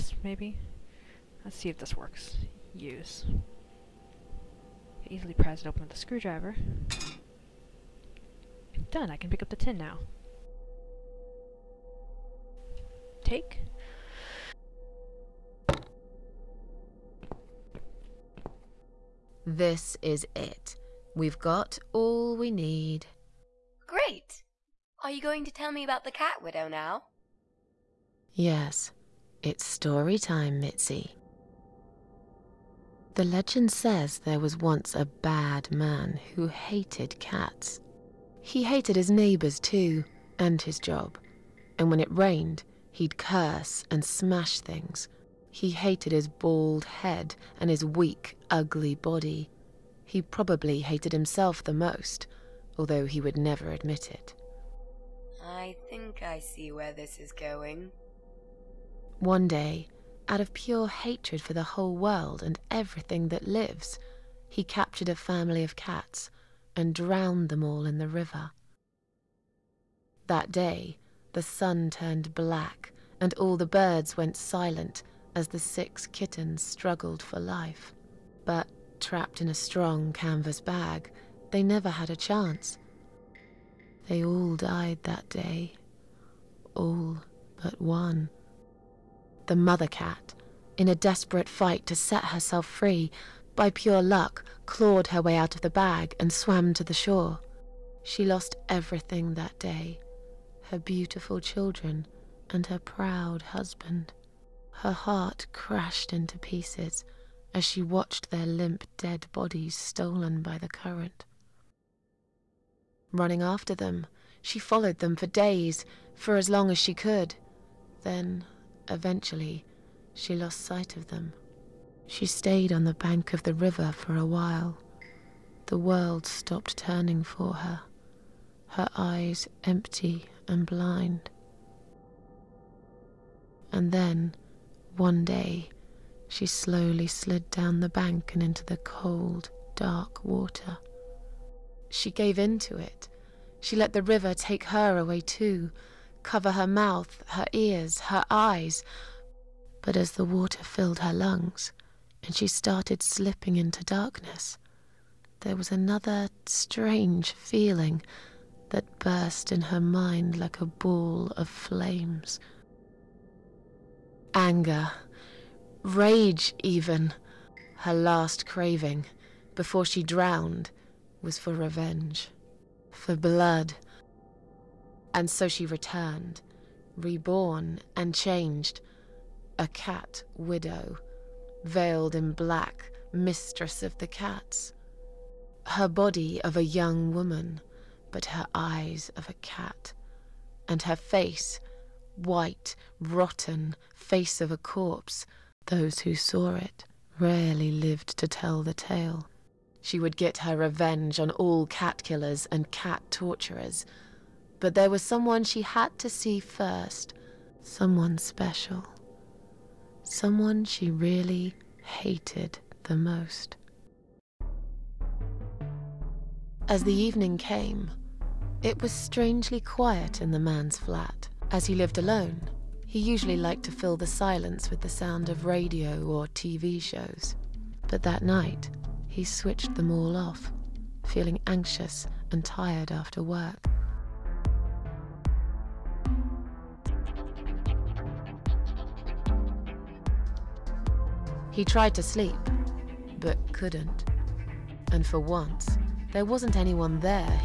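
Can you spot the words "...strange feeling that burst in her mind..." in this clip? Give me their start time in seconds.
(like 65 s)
156 s.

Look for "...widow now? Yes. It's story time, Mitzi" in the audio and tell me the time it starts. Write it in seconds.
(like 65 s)
26 s.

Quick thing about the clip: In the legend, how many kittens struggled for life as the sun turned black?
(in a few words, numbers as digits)
6.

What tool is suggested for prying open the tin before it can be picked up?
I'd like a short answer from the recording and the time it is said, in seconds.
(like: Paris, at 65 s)
Screwdriver, at 5 s.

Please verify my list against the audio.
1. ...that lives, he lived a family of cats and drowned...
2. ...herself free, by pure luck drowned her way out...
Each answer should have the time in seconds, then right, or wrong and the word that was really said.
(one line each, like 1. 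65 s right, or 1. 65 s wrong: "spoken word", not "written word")
1. 63 s wrong: "captured", not "lived"
2. 92 s wrong: "clawed", not "drowned".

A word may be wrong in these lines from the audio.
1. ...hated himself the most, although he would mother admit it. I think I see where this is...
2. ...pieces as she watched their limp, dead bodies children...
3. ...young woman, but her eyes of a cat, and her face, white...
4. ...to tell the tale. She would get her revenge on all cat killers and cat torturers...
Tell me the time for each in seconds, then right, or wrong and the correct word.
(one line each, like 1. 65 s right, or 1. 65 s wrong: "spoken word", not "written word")
1. 50 s wrong: "never", not "mother"
2. 106 s wrong: "stolen", not "children"
3. 186 s right
4. 198 s right.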